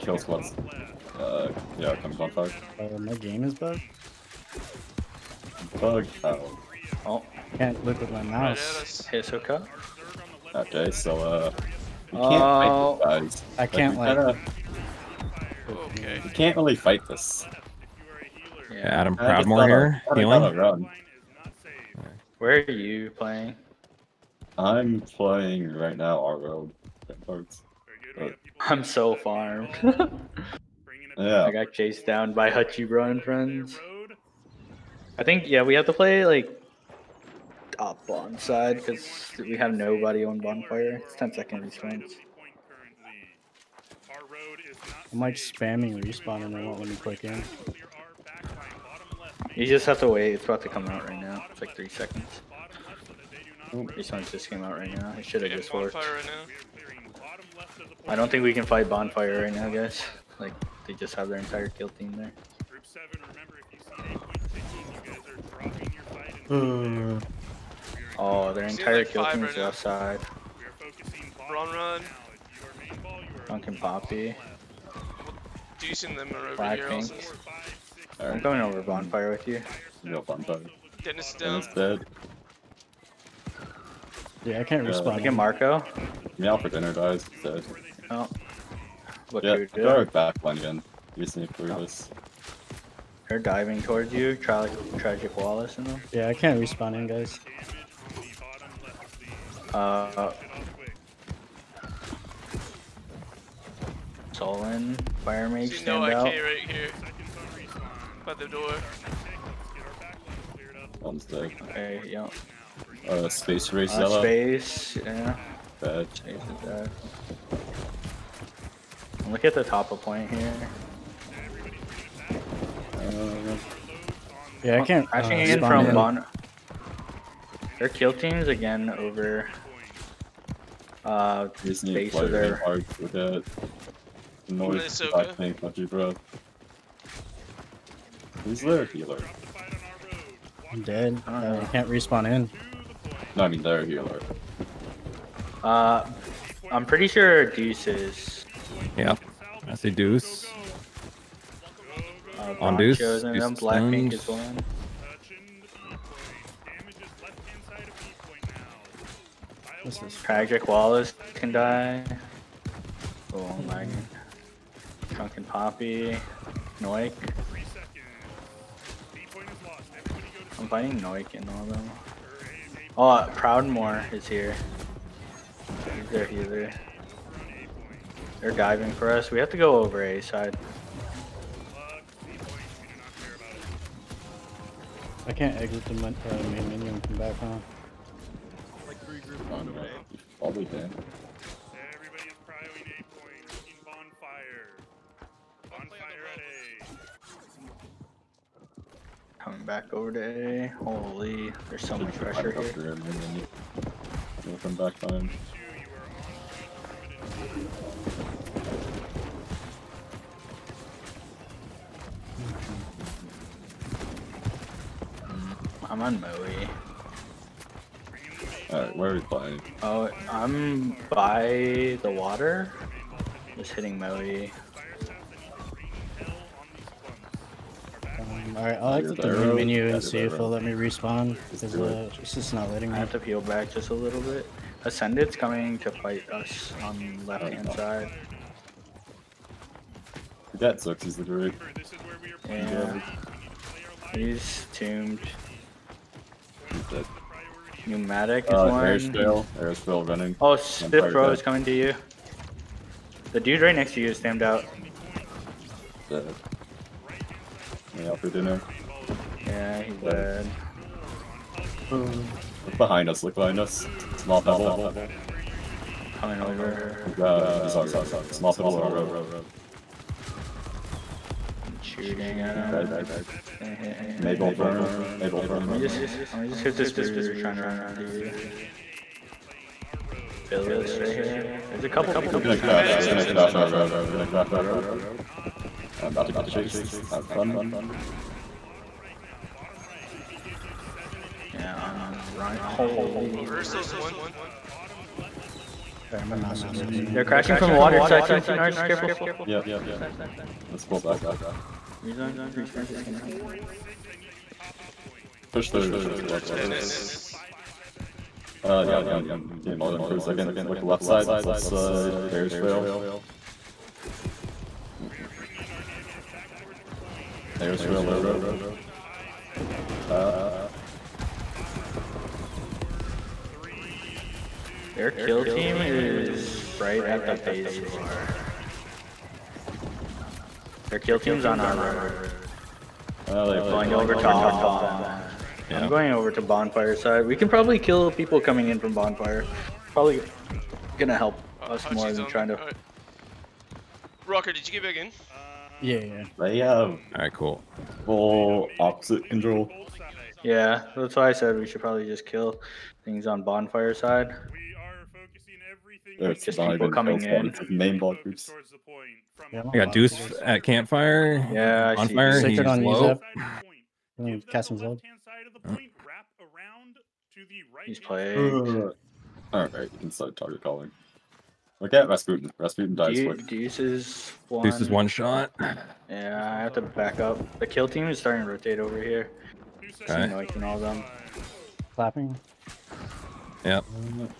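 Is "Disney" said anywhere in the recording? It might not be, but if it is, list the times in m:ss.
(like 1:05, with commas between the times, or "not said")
2:11.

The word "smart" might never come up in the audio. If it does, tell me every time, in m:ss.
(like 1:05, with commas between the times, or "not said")
5:02.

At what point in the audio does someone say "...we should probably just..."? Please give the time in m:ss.
5:51.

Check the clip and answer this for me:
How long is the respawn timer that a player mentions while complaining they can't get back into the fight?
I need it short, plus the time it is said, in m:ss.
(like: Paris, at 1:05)
10 seconds, at 0:41.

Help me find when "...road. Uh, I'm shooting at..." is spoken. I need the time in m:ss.
4:28.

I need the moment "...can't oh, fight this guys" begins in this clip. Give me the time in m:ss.
0:12.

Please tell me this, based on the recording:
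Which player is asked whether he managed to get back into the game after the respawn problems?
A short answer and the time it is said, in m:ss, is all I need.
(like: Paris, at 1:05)
Rocker, at 5:44.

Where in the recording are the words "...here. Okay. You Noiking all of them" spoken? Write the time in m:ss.
6:19.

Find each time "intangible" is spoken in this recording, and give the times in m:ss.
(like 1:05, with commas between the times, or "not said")
not said.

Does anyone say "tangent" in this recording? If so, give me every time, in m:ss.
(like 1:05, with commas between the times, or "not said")
not said.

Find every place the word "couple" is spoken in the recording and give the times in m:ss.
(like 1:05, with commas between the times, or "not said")
4:41.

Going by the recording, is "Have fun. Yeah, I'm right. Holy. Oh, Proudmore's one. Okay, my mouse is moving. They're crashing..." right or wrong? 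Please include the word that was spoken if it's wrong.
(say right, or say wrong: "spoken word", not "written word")
wrong: "Urso", not "Proudmore".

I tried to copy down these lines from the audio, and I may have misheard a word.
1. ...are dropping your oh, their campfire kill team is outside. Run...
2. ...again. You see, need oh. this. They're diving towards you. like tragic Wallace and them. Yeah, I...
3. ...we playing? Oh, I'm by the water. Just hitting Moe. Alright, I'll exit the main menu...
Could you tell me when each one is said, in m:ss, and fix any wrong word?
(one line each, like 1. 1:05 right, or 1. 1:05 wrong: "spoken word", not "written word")
1. 1:05 wrong: "entire", not "campfire"
2. 1:30 right
3. 3:39 right.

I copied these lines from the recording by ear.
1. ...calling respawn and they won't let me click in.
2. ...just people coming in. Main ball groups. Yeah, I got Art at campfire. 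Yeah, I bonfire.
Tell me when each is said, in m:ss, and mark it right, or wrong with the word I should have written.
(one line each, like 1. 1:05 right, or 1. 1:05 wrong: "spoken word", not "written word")
1. 0:45 wrong: "spamming", not "calling"
2. 5:56 wrong: "Deuce", not "Art".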